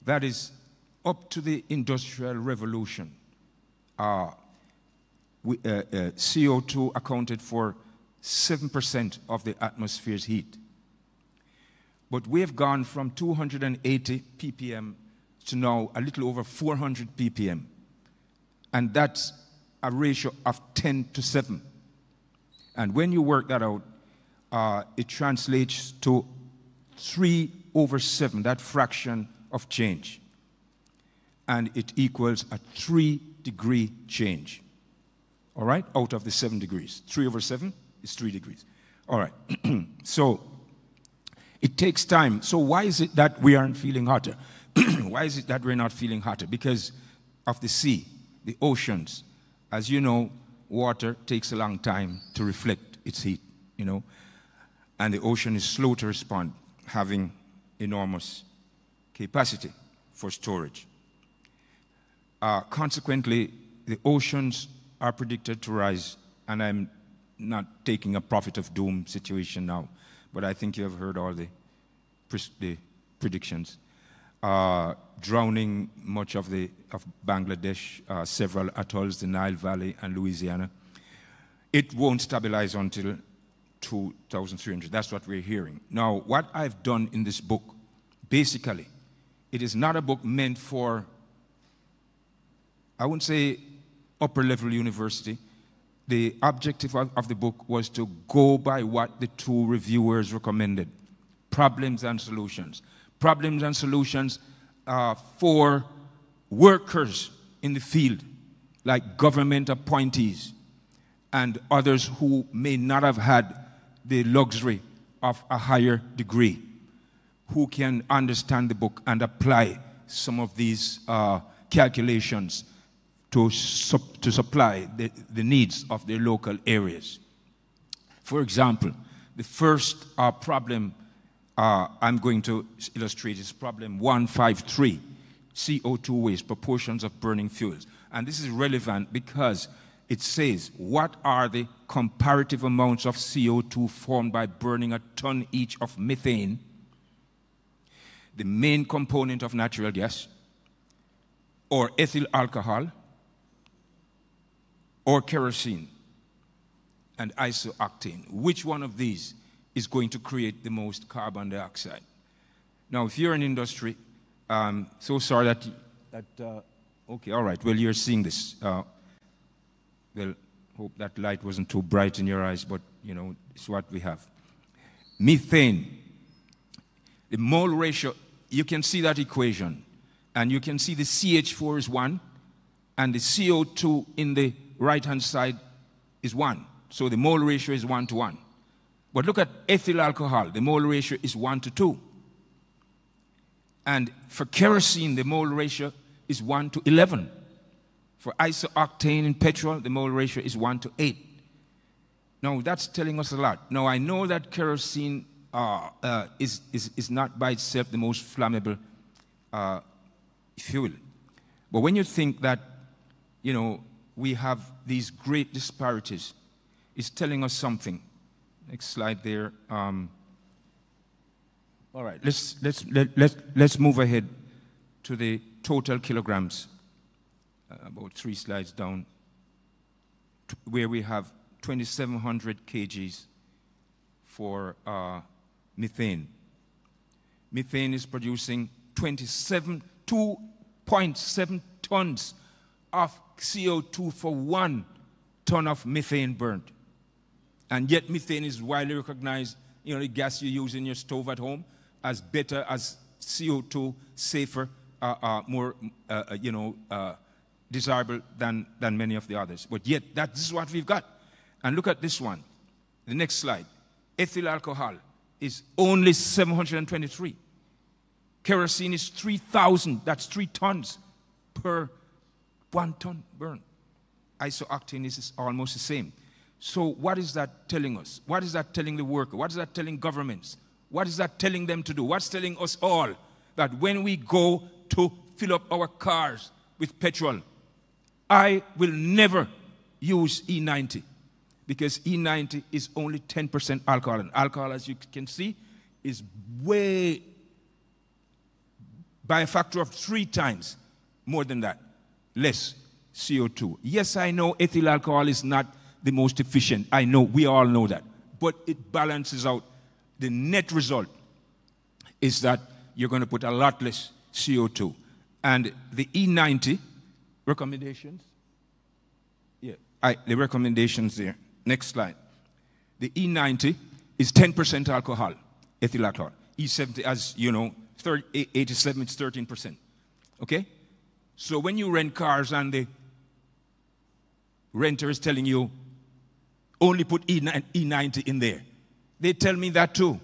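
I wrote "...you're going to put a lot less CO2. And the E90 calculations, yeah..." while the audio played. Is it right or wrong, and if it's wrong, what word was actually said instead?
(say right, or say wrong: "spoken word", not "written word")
wrong: "recommendations", not "calculations".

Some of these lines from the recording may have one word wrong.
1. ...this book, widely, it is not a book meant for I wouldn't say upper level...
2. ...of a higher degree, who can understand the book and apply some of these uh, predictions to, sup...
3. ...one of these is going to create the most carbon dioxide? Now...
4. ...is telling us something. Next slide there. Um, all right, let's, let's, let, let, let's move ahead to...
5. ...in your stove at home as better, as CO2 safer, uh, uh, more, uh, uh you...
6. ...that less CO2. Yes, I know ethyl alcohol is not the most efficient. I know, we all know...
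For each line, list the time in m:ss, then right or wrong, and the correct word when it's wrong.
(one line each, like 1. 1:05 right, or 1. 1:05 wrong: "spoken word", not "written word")
1. 1:27 wrong: "basically", not "widely"
2. 1:55 wrong: "calculations", not "predictions"
3. 2:38 right
4. 3:36 right
5. 4:10 right
6. 5:01 right.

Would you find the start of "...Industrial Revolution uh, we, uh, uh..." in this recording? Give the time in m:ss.
0:01.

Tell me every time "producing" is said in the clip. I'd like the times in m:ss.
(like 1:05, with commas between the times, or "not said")
3:58.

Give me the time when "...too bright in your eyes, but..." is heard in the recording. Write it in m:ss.
2:51.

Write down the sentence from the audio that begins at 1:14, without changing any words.
Uh, drowning much of, the, of Bangladesh, uh, several atolls, the Nile Valley, and Louisiana.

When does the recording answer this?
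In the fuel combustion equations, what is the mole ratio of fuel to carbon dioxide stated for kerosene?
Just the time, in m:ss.
3:16.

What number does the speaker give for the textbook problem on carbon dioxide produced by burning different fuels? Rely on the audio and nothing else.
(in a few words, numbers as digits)
153.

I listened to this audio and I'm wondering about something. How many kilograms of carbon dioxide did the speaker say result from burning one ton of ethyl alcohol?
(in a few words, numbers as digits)
723.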